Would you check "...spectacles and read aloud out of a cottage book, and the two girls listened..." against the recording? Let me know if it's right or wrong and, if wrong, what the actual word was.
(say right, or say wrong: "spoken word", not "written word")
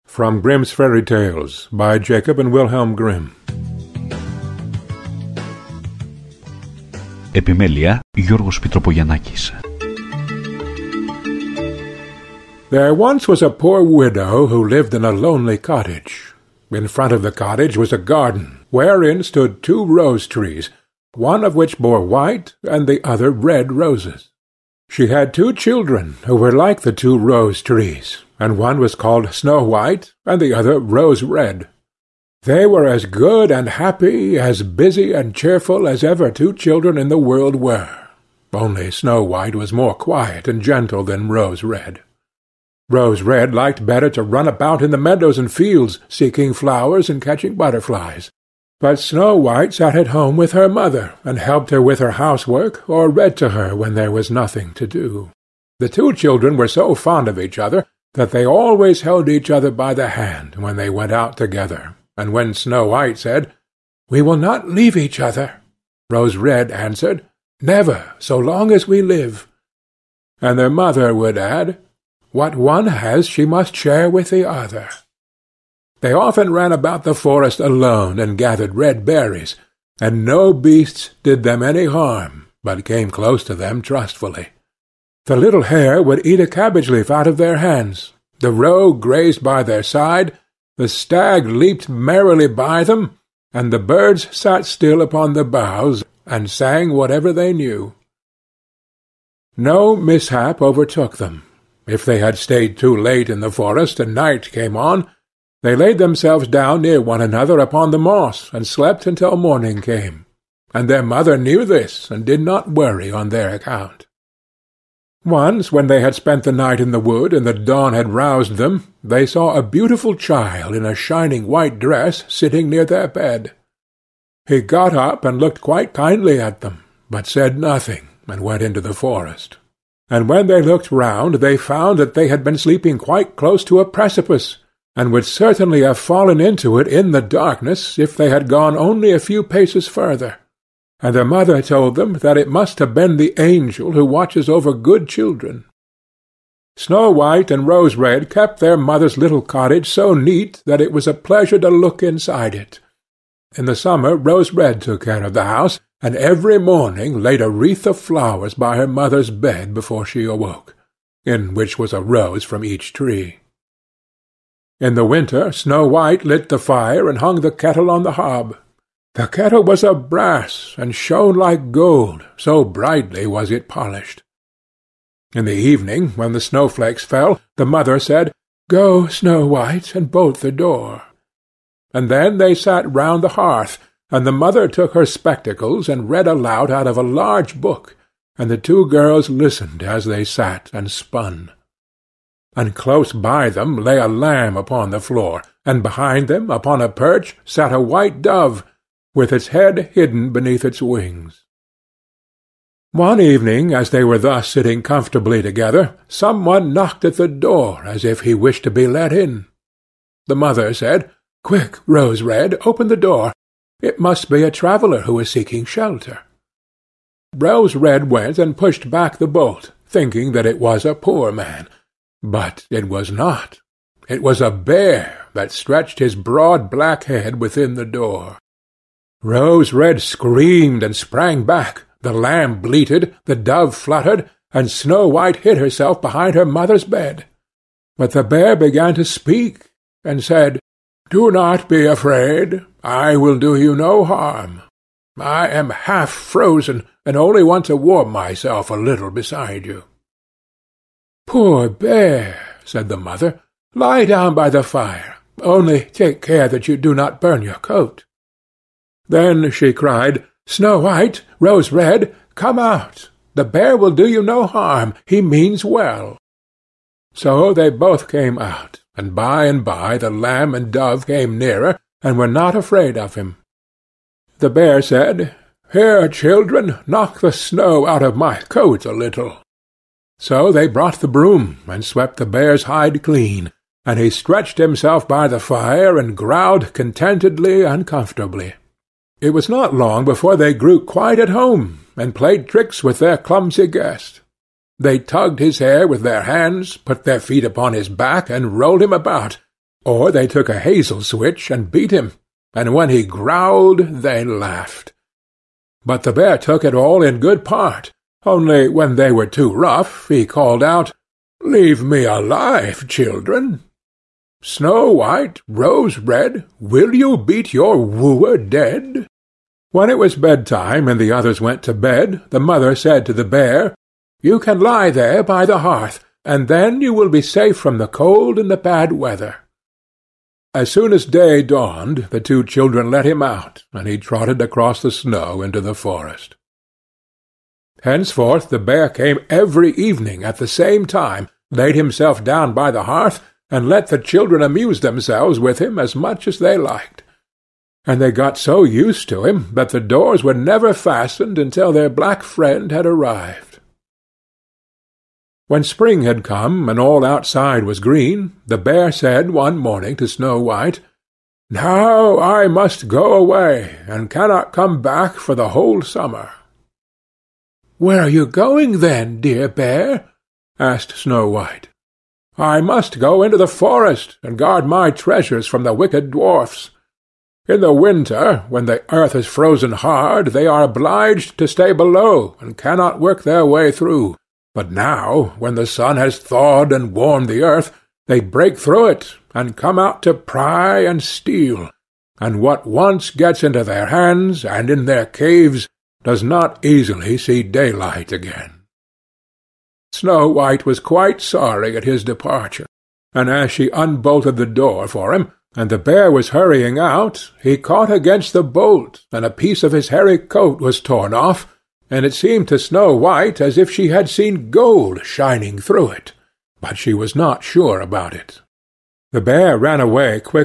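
wrong: "large", not "cottage".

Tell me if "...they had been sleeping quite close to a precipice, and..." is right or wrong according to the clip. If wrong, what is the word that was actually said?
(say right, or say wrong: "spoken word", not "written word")
right.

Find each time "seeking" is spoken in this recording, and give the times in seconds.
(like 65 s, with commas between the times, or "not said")
46 s, 215 s.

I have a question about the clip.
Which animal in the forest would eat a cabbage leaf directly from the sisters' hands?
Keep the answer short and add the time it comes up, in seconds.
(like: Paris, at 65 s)
The little hare, at 85 s.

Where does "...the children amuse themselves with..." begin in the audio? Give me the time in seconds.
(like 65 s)
343 s.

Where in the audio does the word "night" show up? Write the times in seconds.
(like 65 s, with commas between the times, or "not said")
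104 s, 116 s.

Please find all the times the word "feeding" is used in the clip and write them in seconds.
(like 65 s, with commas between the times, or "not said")
not said.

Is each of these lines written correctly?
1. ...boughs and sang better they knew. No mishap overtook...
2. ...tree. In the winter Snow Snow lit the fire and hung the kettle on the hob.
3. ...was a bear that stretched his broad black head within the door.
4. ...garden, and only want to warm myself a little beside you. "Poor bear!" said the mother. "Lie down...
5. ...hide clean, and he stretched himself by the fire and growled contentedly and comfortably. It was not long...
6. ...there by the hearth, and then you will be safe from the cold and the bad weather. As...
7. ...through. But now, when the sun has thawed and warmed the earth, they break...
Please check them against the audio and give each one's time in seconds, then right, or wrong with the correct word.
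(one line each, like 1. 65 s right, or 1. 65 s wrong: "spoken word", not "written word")
1. 95 s wrong: "whatever", not "better"
2. 162 s wrong: "White", not "Snow"
3. 224 s right
4. 246 s wrong: "frozen", not "garden"
5. 282 s right
6. 324 s right
7. 383 s right.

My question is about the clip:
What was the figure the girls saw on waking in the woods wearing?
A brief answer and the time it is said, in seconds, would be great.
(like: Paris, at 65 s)
A shining white dress, at 120 s.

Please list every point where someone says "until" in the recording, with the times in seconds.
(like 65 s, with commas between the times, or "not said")
109 s, 351 s.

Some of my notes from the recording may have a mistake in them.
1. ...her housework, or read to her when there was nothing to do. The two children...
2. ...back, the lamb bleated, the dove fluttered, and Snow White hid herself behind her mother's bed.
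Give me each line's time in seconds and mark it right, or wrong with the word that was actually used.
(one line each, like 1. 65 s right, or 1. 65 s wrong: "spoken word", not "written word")
1. 51 s right
2. 231 s right.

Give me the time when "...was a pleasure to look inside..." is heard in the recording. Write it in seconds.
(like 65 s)
150 s.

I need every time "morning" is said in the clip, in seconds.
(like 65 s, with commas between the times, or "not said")
109 s, 156 s, 359 s.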